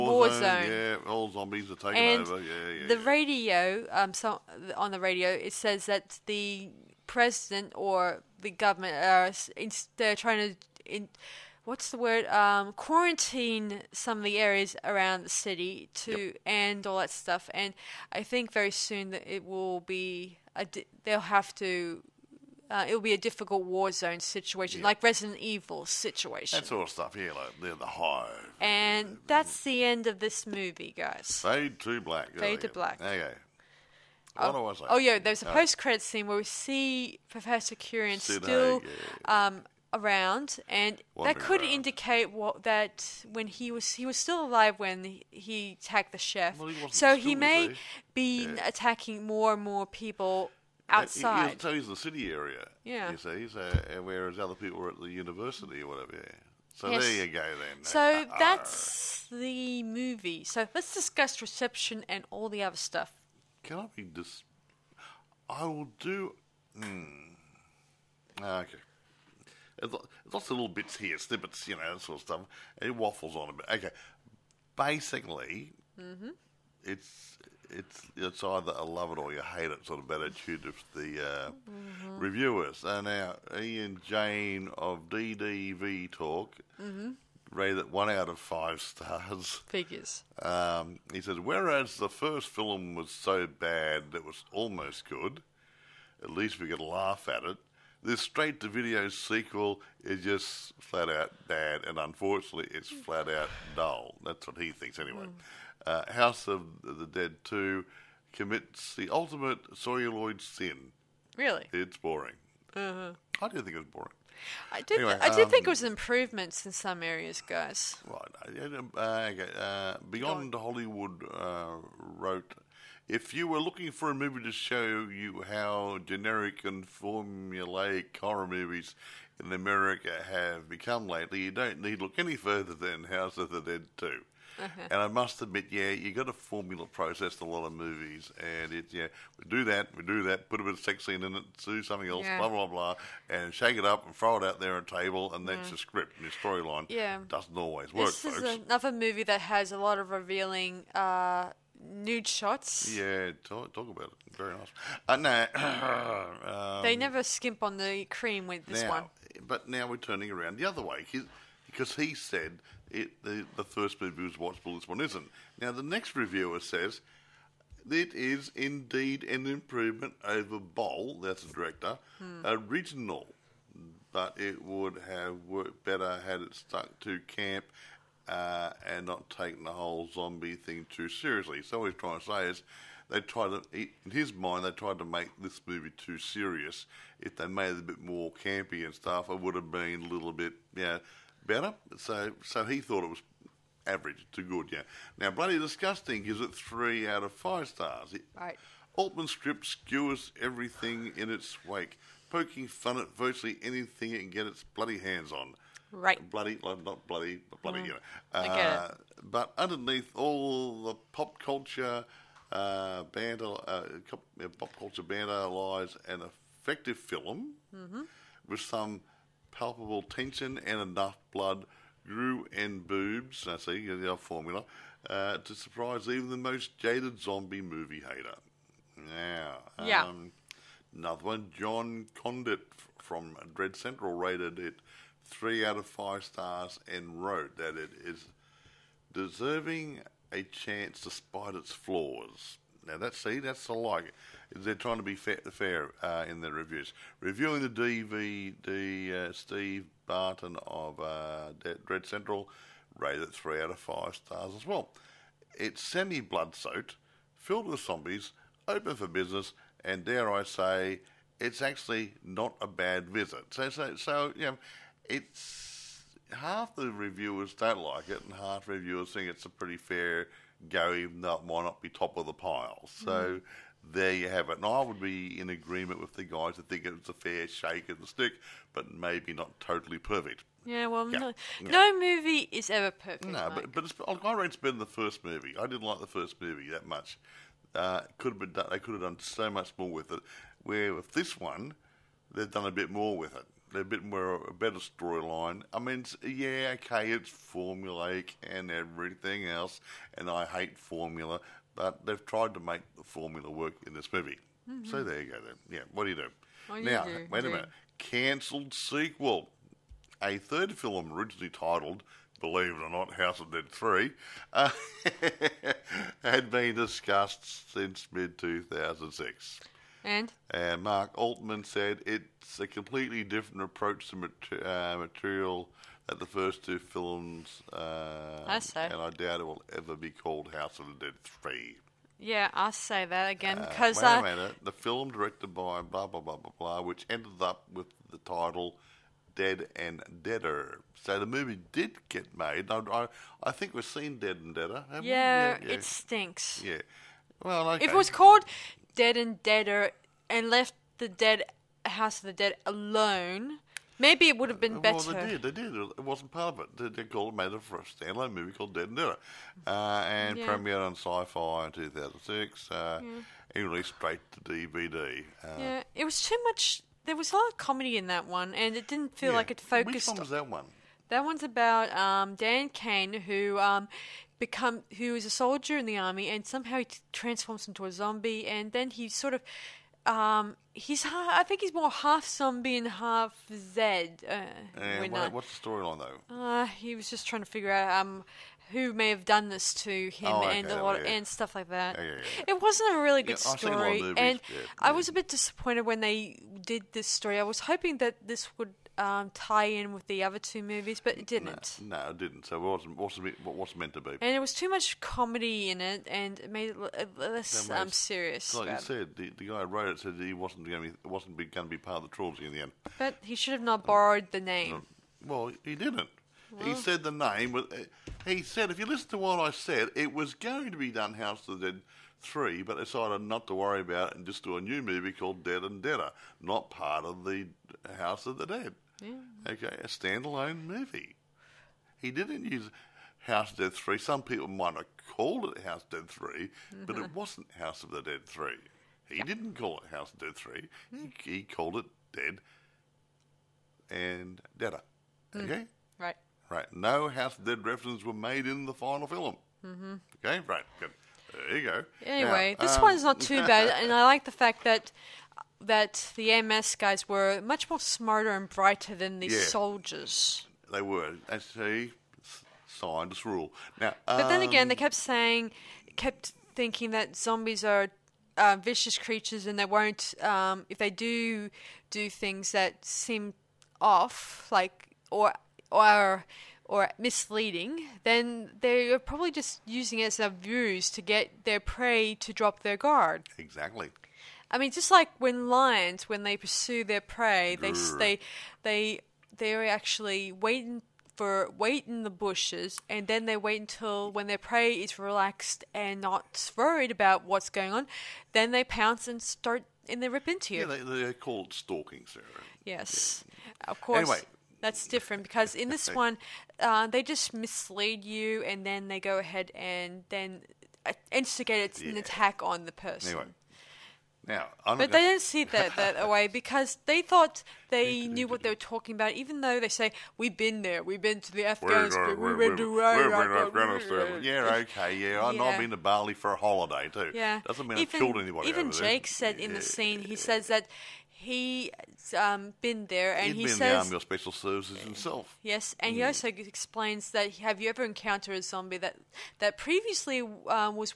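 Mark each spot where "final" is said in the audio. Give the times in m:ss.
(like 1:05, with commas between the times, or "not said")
7:28.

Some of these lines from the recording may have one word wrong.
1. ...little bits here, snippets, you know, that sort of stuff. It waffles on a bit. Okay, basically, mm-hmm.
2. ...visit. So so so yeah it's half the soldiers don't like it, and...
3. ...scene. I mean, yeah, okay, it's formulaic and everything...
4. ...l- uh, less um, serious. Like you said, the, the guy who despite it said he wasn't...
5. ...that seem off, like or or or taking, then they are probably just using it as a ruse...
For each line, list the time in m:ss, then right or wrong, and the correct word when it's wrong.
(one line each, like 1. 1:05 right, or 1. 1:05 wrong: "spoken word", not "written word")
1. 1:10 right
2. 4:23 wrong: "reviewers", not "soldiers"
3. 4:54 wrong: "storyline", not "scene"
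4. 6:46 wrong: "wrote", not "despite"
5. 7:52 wrong: "misleading", not "taking".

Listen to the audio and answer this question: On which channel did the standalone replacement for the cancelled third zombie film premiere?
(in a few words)
Sci-Fi.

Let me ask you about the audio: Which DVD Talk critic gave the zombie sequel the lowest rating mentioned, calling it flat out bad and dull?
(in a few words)
Ian Jane.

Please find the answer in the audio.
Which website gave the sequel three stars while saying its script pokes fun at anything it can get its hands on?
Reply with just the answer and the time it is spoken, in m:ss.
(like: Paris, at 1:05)
Bloody Disgusting, at 3:15.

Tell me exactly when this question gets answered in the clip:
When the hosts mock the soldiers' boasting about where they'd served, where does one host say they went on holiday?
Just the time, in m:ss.
8:45.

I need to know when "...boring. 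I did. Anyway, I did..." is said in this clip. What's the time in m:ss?
1:53.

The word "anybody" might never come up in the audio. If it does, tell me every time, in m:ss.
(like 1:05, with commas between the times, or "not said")
8:48.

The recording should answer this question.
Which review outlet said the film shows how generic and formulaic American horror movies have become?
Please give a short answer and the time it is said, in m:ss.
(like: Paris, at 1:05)
Beyond Hollywood, at 2:00.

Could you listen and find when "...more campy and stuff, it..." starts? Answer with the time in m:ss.
3:08.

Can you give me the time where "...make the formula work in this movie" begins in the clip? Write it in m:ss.
5:02.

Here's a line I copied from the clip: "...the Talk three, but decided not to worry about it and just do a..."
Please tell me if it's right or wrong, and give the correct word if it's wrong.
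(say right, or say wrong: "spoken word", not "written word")
wrong: "Dead", not "Talk".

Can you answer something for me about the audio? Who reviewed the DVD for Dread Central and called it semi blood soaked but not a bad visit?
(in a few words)
Steve Barton.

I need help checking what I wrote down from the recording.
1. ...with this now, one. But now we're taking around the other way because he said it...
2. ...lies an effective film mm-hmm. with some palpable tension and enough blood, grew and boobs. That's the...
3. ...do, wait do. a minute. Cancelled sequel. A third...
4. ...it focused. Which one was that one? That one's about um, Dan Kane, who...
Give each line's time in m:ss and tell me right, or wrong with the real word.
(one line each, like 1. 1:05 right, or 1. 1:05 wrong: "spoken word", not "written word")
1. 2:38 wrong: "turning", not "taking"
2. 3:35 right
3. 5:07 right
4. 6:09 right.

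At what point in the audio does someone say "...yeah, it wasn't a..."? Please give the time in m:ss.
6:32.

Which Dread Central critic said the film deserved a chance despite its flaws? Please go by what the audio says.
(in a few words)
Jon Condit.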